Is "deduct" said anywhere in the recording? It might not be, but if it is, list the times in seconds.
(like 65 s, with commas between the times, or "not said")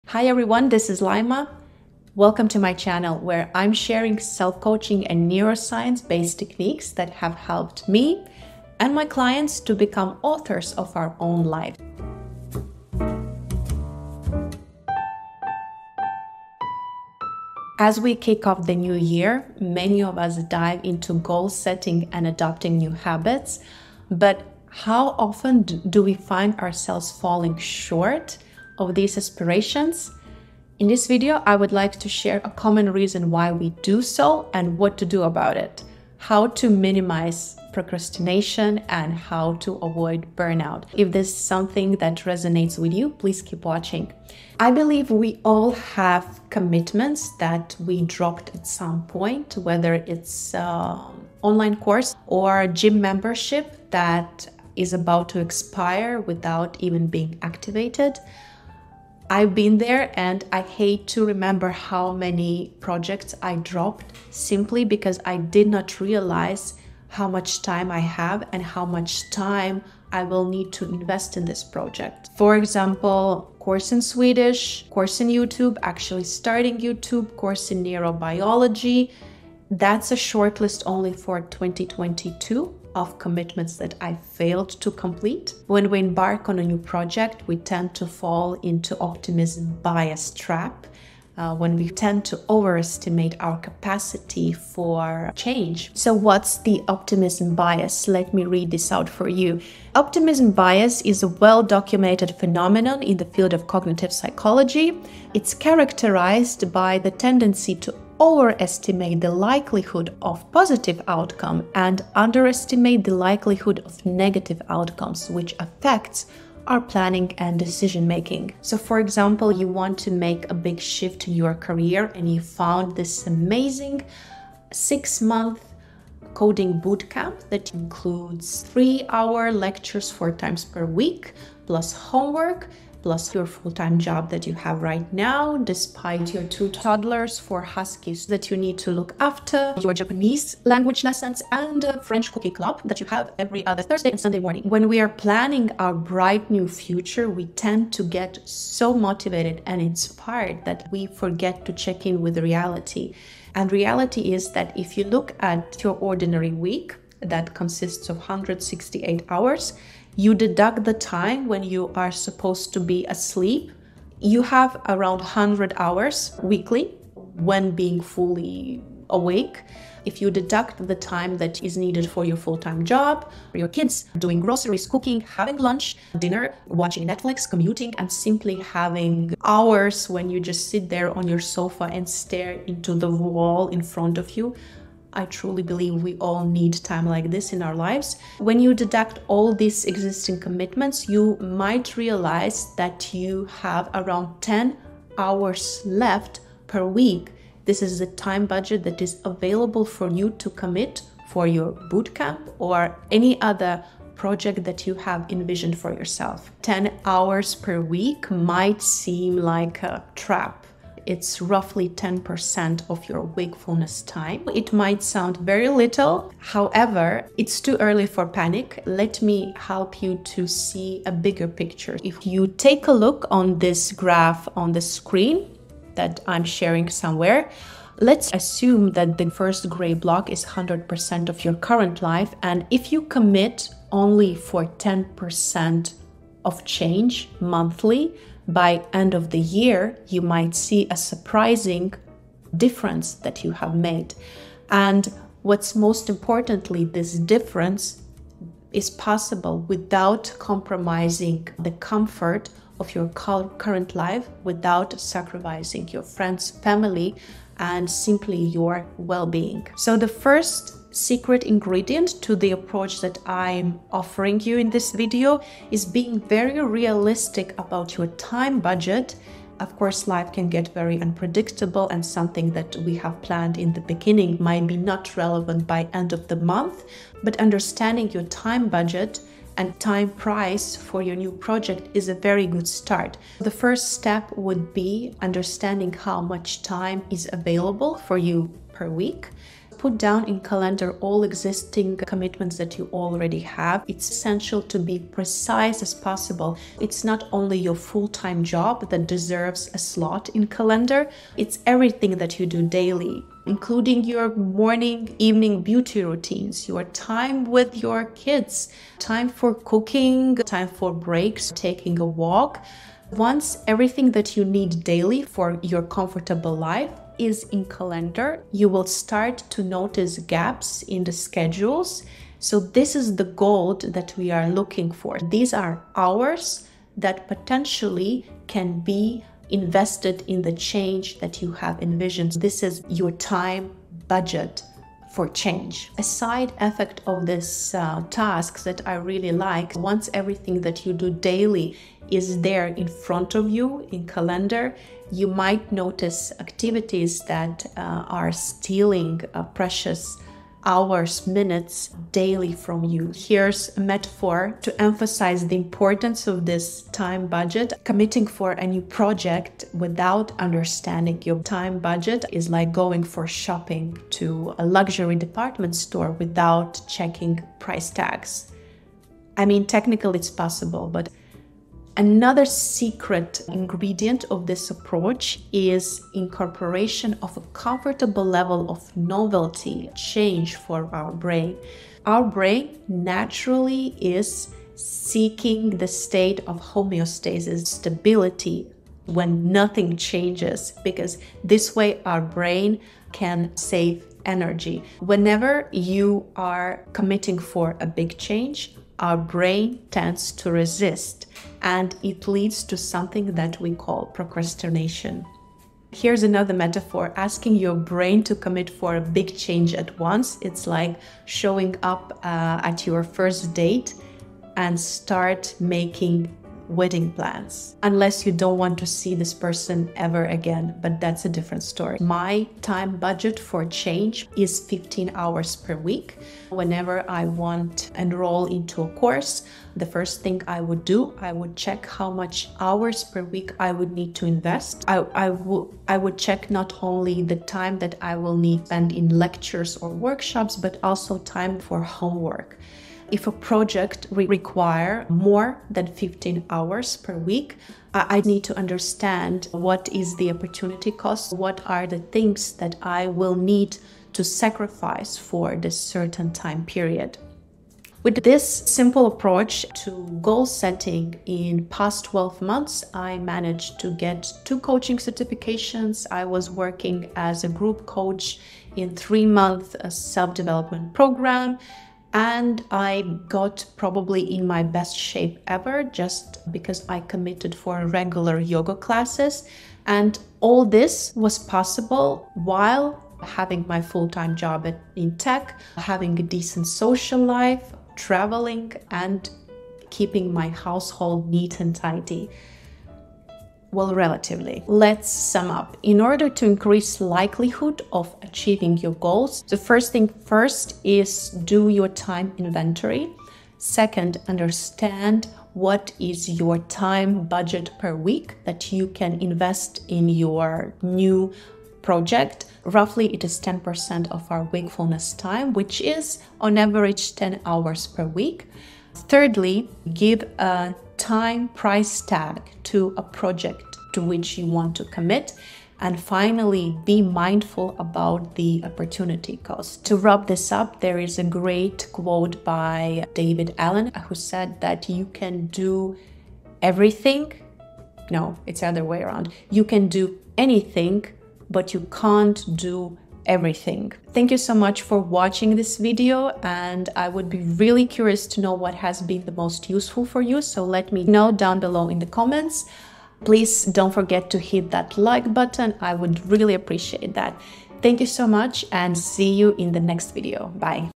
160 s, 170 s, 188 s.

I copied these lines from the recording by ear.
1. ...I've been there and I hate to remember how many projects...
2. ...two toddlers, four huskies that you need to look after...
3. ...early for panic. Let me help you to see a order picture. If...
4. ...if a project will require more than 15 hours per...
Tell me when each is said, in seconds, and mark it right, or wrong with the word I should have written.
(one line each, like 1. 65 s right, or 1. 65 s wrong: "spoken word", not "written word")
1. 59 s right
2. 136 s right
3. 217 s wrong: "bigger", not "order"
4. 443 s right.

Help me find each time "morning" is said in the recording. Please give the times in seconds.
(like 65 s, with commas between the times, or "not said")
144 s, 304 s.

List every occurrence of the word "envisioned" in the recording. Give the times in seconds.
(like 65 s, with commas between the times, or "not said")
205 s, 331 s.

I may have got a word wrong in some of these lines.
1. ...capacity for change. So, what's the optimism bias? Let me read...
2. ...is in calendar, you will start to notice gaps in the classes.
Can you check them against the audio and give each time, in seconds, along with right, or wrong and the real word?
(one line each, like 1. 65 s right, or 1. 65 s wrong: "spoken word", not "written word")
1. 93 s right
2. 317 s wrong: "schedules", not "classes".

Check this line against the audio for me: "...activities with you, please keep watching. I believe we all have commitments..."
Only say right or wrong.
wrong.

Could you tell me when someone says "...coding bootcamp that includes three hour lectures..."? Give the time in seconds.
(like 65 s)
126 s.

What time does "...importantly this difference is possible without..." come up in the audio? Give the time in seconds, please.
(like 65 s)
246 s.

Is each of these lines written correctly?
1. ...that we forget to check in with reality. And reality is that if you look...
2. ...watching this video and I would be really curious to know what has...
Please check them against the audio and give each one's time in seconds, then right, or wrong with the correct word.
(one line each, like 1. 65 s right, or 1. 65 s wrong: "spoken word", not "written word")
1. 150 s right
2. 544 s right.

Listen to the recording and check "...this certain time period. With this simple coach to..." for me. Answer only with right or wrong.
wrong.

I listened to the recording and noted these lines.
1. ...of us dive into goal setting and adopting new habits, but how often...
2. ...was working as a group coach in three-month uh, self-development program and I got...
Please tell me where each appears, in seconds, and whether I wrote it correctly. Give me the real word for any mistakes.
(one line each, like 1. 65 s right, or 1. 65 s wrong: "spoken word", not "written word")
1. 20 s right
2. 466 s right.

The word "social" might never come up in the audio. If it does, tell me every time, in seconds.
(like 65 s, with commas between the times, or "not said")
486 s.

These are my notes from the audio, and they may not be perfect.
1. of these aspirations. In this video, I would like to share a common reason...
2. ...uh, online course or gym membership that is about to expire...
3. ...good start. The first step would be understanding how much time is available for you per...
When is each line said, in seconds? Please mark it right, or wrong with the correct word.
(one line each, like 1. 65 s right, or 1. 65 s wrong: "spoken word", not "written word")
1. 28 s right
2. 50 s right
3. 282 s right.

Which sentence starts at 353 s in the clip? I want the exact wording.
Here's a metaphor to emphasize the importance of this time budget.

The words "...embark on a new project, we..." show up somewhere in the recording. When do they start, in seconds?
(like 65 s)
85 s.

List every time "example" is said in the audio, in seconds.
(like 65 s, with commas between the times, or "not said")
72 s, 118 s.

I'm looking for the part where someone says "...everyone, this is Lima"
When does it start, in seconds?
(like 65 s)
0 s.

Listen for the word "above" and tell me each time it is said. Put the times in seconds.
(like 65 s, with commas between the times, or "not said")
not said.